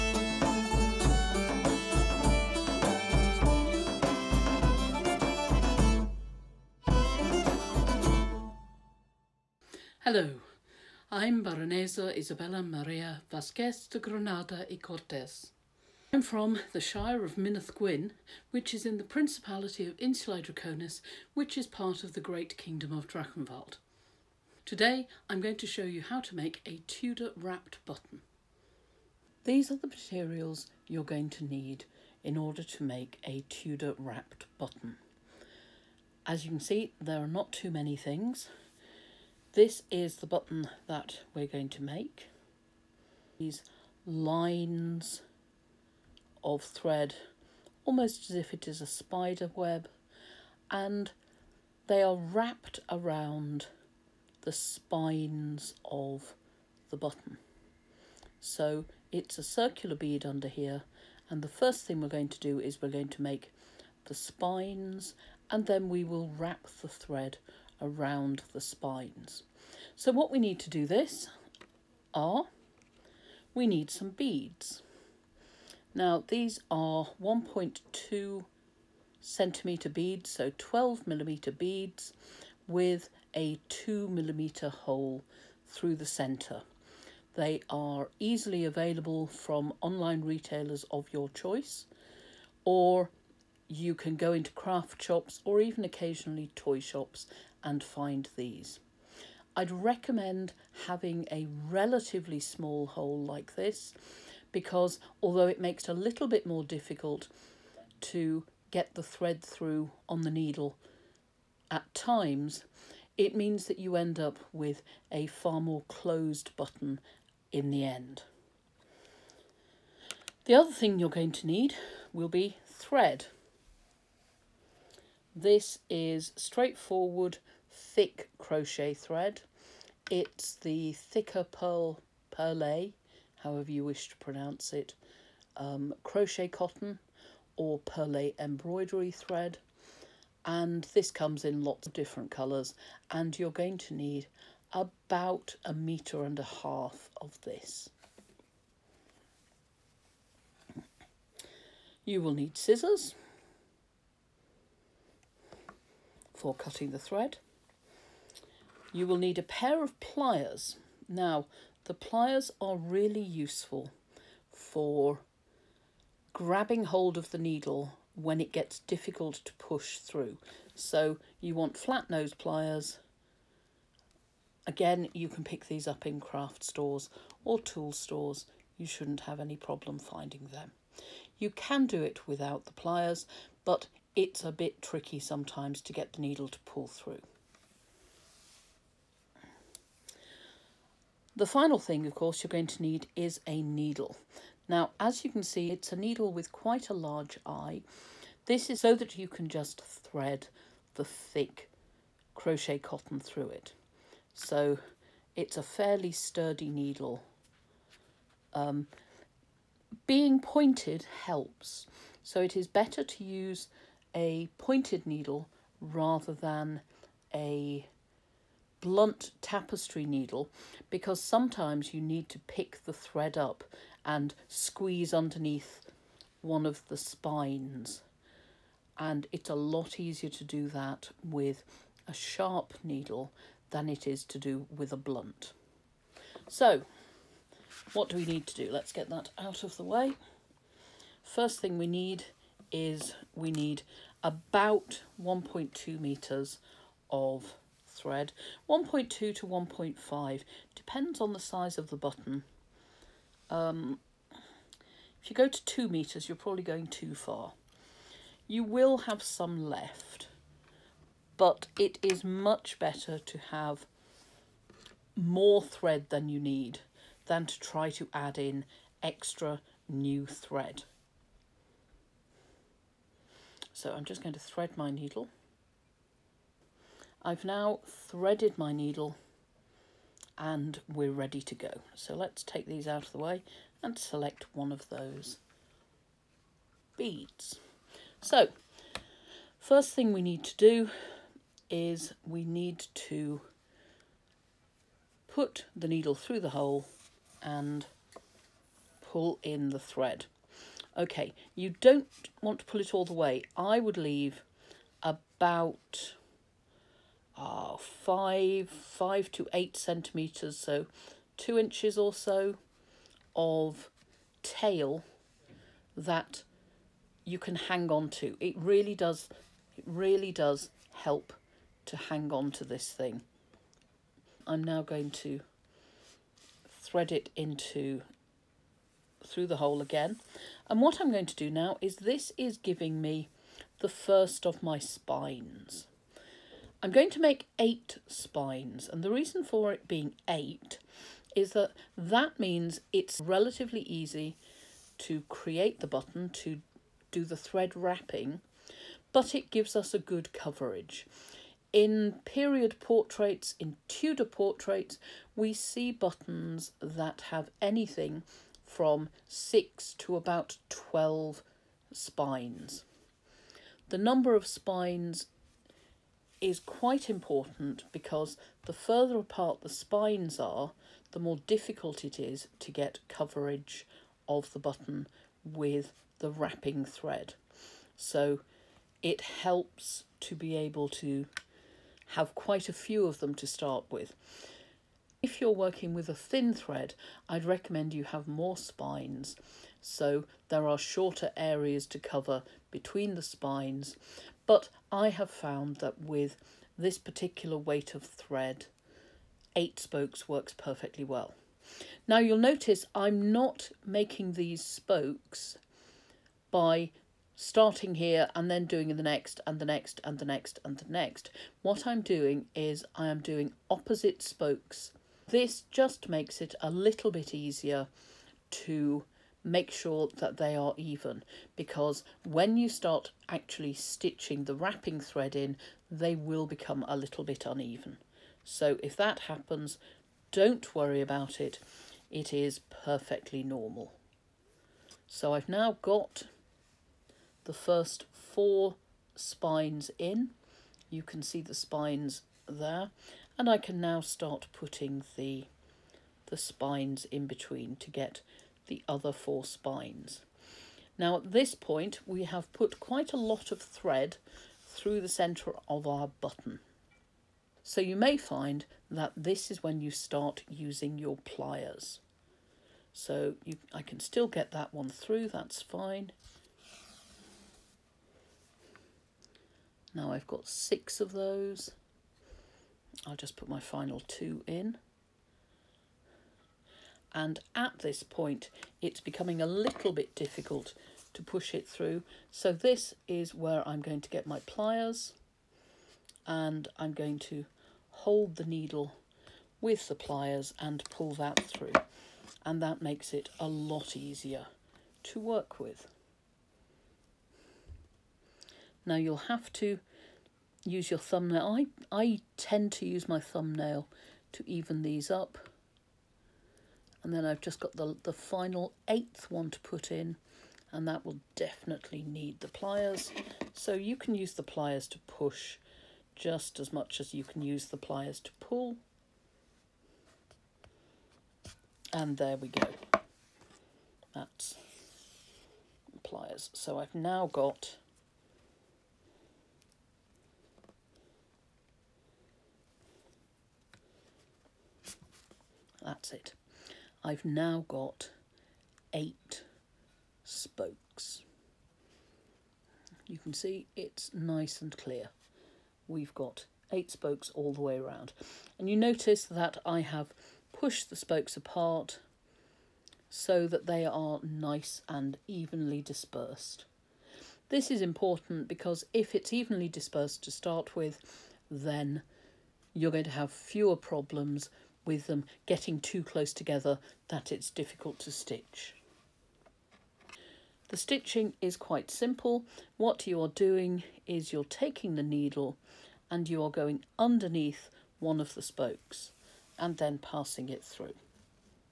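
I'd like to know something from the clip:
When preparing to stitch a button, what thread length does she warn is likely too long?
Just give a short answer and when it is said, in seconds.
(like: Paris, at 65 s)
2 meters, at 255 s.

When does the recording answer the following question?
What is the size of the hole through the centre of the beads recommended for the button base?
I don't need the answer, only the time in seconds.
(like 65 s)
83 s.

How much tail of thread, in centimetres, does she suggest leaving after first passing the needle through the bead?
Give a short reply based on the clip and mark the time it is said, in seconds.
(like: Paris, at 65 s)
5 to 8 centimetres, at 308 s.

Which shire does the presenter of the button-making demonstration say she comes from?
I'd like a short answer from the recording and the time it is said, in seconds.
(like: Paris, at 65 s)
Minas Gwyn, at 17 s.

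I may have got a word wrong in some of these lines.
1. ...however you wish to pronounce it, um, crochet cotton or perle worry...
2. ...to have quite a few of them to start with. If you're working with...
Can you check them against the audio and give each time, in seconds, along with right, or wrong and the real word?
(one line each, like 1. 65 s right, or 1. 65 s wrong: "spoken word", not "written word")
1. 133 s wrong: "embroidery", not "worry"
2. 380 s right.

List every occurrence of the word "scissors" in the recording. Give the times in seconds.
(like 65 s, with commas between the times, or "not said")
152 s.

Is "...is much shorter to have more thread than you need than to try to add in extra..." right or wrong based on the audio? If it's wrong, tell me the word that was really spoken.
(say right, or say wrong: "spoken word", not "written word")
wrong: "better", not "shorter".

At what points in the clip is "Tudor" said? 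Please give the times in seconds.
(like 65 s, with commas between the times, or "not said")
26 s, 33 s, 353 s.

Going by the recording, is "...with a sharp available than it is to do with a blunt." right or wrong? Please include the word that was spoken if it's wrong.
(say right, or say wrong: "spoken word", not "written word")
wrong: "needle", not "available".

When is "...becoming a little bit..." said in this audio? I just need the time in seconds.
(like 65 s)
478 s.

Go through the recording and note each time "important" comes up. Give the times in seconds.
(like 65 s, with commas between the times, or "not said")
367 s, 557 s.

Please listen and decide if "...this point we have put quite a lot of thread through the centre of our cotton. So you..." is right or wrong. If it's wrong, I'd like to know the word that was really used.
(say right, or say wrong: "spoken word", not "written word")
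wrong: "button", not "cotton".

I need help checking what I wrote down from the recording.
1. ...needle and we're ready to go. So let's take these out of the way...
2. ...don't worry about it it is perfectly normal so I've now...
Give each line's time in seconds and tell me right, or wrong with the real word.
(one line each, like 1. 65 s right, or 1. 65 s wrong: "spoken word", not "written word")
1. 278 s right
2. 430 s right.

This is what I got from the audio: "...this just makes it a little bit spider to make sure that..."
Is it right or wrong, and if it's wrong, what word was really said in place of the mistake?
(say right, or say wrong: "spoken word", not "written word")
wrong: "easier", not "spider".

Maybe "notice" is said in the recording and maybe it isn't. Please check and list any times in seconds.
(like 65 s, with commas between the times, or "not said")
402 s, 548 s.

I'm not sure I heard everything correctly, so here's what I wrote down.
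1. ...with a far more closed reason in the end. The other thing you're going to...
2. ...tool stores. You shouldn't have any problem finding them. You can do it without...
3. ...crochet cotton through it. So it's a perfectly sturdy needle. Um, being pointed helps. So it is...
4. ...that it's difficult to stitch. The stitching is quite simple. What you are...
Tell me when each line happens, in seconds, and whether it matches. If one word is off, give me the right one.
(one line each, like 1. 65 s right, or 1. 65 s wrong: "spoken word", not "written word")
1. 114 s wrong: "button", not "reason"
2. 177 s right
3. 202 s wrong: "fairly", not "perfectly"
4. 567 s right.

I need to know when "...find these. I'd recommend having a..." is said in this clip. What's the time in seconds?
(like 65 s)
97 s.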